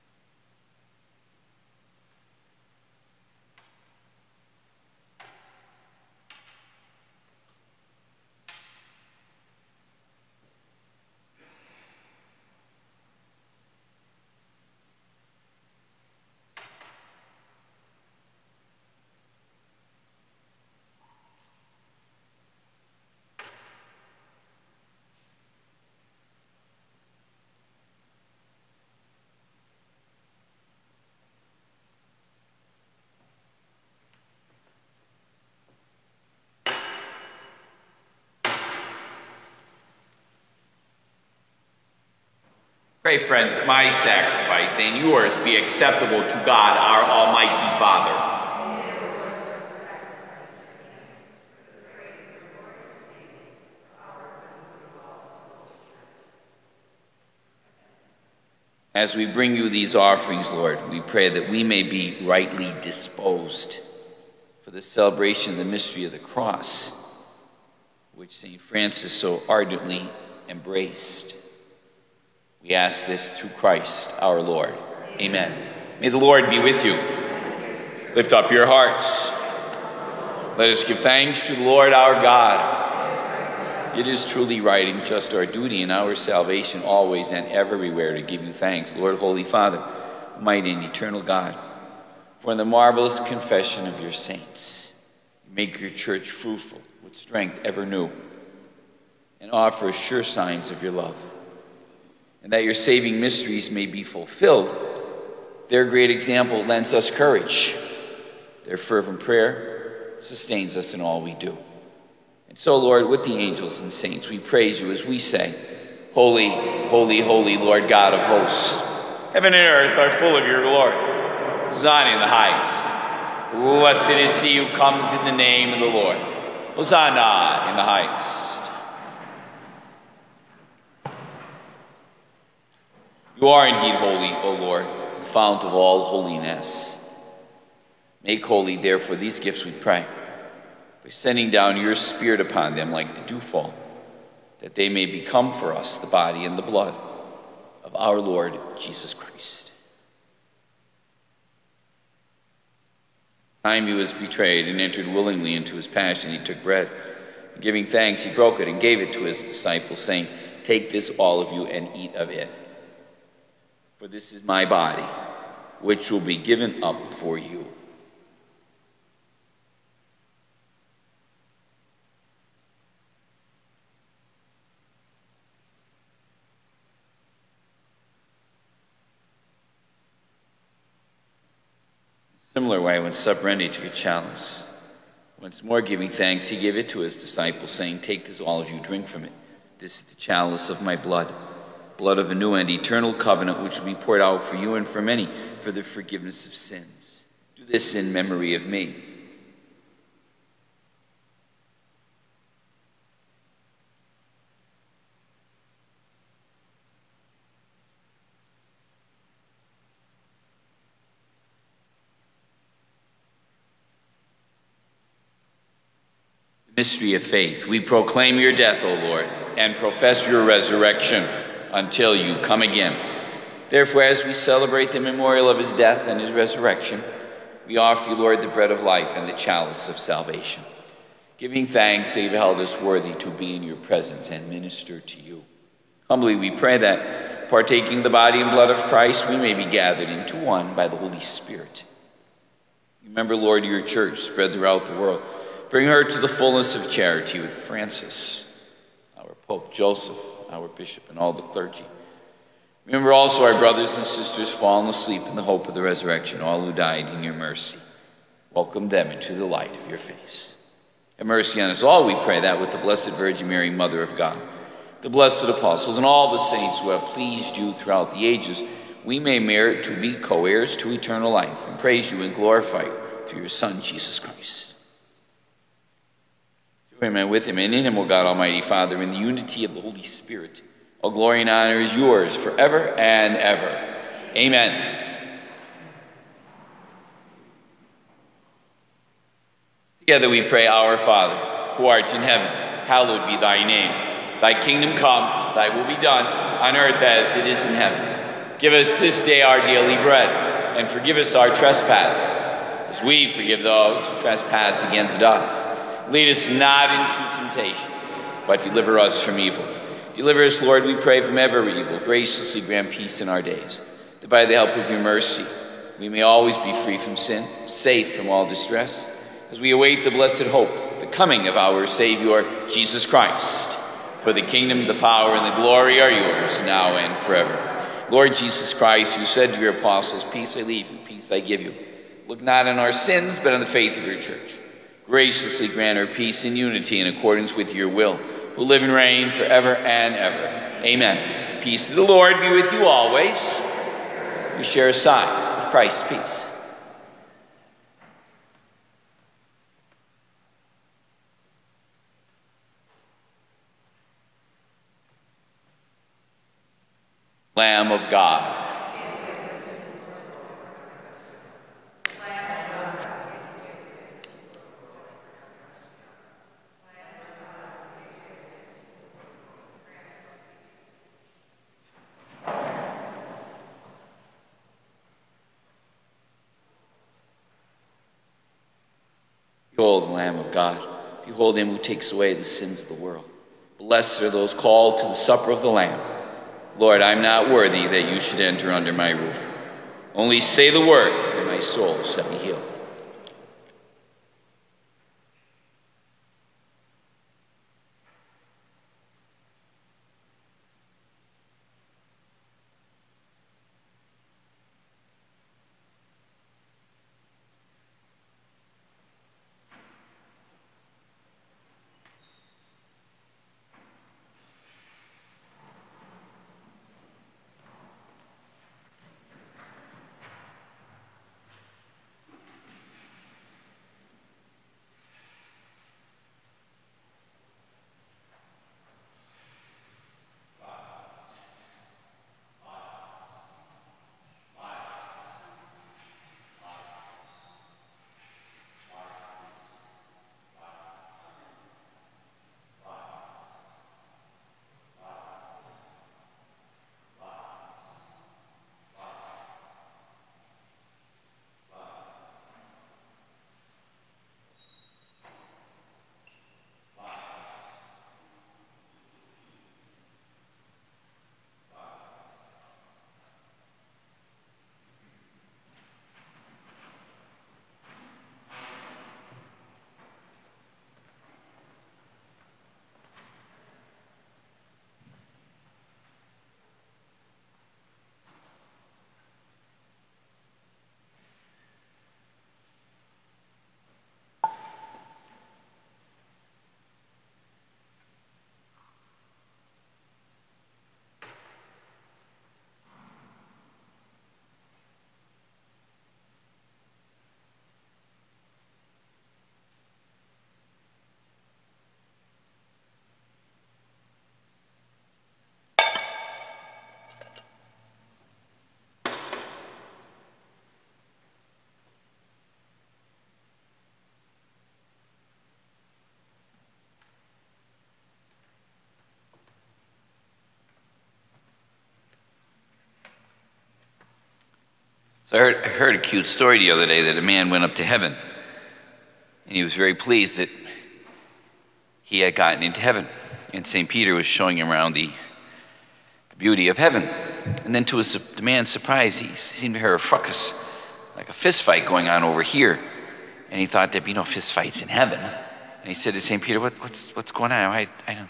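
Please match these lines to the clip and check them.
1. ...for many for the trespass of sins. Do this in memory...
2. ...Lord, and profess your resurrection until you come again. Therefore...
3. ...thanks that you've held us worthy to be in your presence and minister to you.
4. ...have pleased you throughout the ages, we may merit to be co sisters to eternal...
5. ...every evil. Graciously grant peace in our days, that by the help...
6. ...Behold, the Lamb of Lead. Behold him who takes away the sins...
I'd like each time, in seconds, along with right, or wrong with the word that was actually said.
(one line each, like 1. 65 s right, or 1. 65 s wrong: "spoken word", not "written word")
1. 194 s wrong: "forgiveness", not "trespass"
2. 219 s right
3. 231 s right
4. 266 s wrong: "heirs", not "sisters"
5. 311 s right
6. 379 s wrong: "God", not "Lead".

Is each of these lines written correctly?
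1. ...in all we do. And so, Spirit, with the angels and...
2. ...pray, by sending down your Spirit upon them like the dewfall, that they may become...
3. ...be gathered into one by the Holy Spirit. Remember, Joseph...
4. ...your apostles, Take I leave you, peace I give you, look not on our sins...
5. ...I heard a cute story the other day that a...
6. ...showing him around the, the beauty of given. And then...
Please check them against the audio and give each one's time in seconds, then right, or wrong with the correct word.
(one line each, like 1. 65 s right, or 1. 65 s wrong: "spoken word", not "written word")
1. 110 s wrong: "Lord", not "Spirit"
2. 139 s right
3. 239 s wrong: "Lord", not "Joseph"
4. 329 s wrong: "Peace", not "Take"
5. 525 s right
6. 534 s wrong: "heaven", not "given".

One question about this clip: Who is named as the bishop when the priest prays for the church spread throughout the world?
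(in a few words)
Joseph.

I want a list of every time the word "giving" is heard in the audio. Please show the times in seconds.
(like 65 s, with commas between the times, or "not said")
157 s, 185 s, 231 s.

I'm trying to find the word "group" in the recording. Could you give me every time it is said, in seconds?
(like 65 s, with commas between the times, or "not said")
not said.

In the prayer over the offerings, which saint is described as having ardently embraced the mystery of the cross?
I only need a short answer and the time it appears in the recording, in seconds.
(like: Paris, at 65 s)
St. Francis, at 68 s.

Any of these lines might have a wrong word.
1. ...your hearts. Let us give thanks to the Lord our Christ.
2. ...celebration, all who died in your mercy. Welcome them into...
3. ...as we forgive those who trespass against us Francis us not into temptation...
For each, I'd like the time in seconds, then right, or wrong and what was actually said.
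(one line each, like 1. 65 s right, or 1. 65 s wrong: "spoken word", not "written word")
1. 78 s wrong: "God", not "Christ"
2. 255 s wrong: "resurrection", not "celebration"
3. 302 s wrong: "Lead", not "Francis".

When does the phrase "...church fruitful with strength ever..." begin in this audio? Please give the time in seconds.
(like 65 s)
95 s.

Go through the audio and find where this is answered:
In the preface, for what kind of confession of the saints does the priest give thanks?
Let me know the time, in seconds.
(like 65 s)
92 s.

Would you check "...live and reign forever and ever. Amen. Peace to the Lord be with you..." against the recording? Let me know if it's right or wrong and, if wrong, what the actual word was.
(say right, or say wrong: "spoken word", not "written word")
right.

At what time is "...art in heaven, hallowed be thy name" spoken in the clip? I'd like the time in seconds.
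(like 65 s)
291 s.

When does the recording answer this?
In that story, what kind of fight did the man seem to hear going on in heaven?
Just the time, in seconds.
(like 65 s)
541 s.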